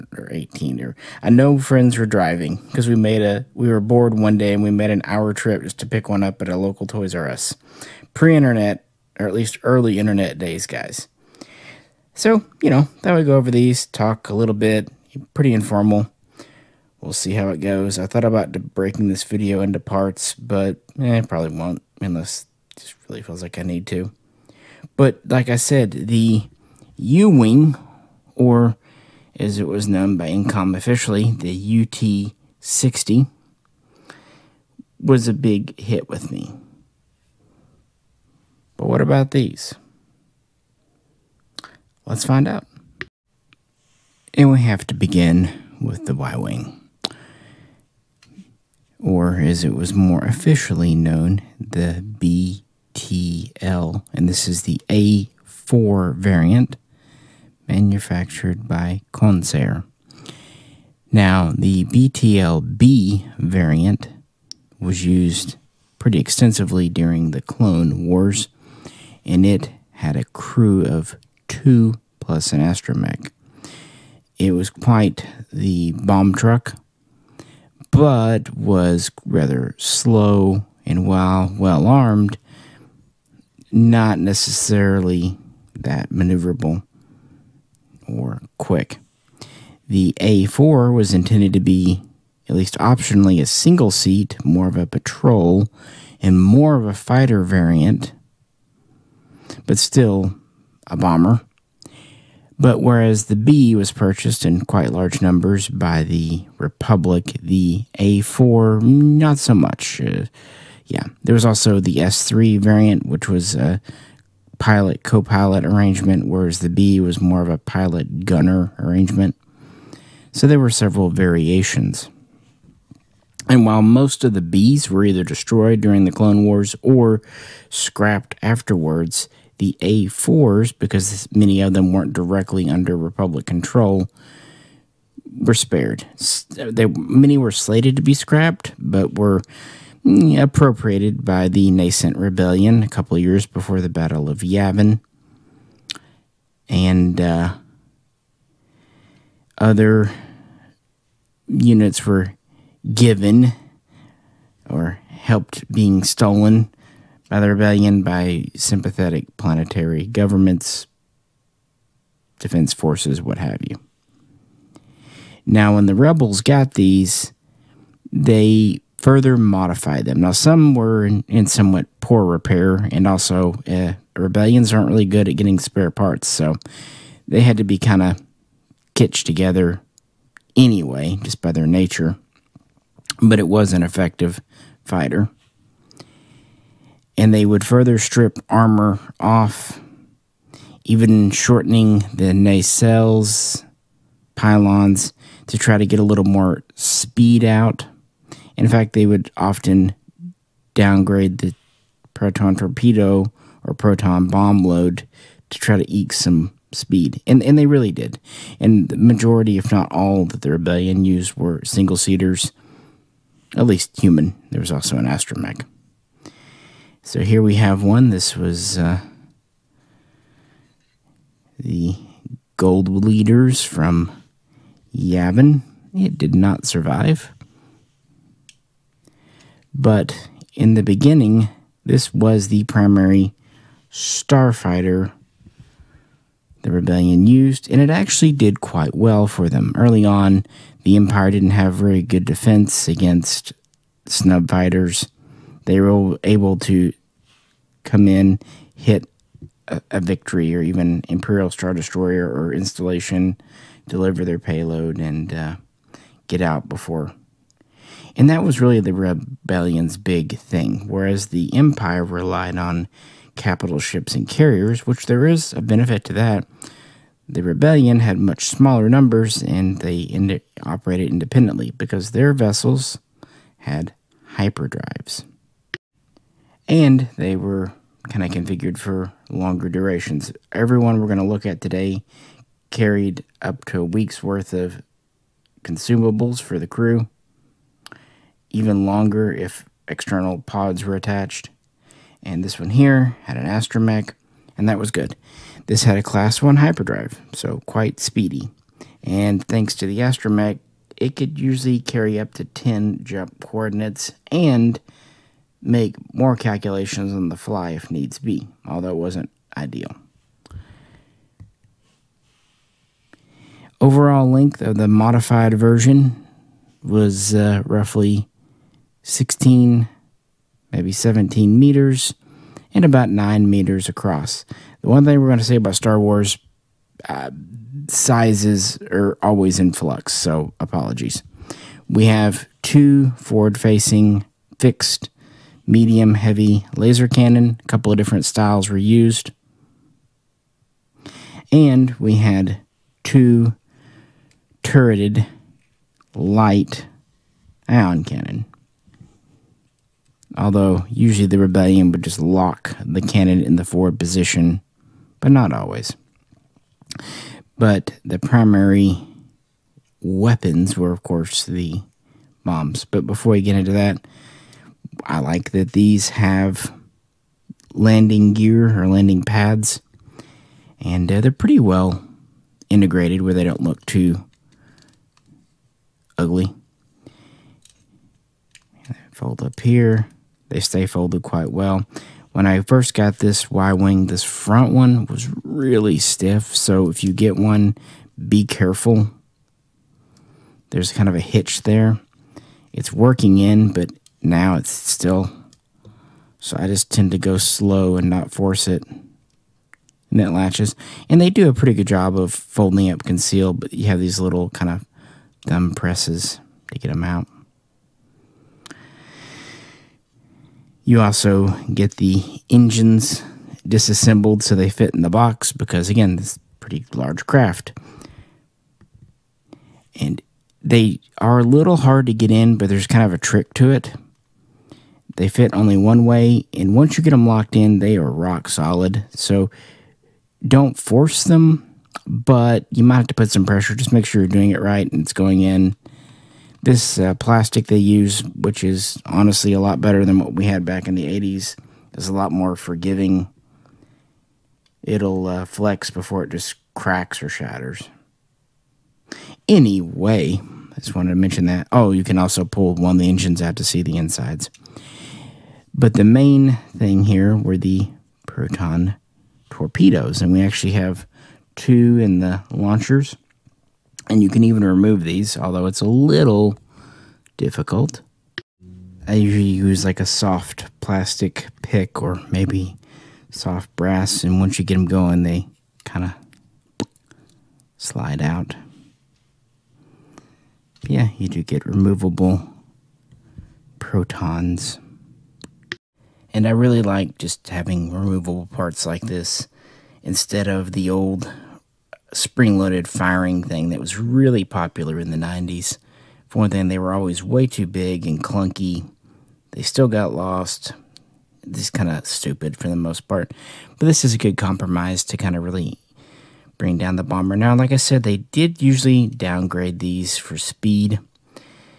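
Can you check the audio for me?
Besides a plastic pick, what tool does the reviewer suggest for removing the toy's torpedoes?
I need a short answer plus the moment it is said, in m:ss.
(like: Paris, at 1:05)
soft brass, at 7:53.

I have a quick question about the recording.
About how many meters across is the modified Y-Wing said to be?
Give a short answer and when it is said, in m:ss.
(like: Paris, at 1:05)
9 meters, at 5:23.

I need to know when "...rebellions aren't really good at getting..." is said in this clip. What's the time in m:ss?
2:54.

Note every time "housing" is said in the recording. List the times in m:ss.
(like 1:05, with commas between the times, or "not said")
not said.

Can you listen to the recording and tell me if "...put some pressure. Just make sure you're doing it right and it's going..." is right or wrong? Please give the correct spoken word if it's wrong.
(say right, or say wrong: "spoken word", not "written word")
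right.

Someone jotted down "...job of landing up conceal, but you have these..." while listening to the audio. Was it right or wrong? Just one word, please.
wrong.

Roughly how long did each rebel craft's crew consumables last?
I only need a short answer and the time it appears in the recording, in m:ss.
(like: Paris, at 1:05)
a week's worth, at 4:43.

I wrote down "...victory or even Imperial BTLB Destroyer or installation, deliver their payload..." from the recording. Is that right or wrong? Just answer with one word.
wrong.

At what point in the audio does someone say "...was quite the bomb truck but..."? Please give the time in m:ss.
1:14.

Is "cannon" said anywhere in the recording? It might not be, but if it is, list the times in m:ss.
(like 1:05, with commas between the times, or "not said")
5:37, 5:48, 5:53.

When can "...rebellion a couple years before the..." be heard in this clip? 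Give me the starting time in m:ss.
2:22.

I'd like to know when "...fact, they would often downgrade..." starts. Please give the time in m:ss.
3:18.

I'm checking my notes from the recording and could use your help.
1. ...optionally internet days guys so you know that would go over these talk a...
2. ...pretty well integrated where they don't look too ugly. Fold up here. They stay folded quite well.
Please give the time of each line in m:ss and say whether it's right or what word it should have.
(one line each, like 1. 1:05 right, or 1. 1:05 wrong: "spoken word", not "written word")
1. 0:09 wrong: "early", not "optionally"
2. 6:11 right.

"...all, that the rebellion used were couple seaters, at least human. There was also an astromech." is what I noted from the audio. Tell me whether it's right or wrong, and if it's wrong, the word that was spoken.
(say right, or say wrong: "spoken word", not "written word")
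wrong: "single", not "couple".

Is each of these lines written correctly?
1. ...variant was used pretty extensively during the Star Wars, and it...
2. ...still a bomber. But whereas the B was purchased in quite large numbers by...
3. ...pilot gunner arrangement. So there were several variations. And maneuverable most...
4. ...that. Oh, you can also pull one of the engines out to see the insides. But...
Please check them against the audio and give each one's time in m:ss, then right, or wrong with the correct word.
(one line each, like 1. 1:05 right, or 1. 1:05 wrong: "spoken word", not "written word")
1. 1:03 wrong: "Clone", not "Star"
2. 1:39 right
3. 1:57 wrong: "while", not "maneuverable"
4. 7:31 right.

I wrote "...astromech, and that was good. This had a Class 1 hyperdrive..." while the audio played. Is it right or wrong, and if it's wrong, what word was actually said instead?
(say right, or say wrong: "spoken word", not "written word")
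right.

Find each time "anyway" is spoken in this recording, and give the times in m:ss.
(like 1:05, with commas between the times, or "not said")
3:00, 7:29.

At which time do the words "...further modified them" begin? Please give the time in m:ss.
2:48.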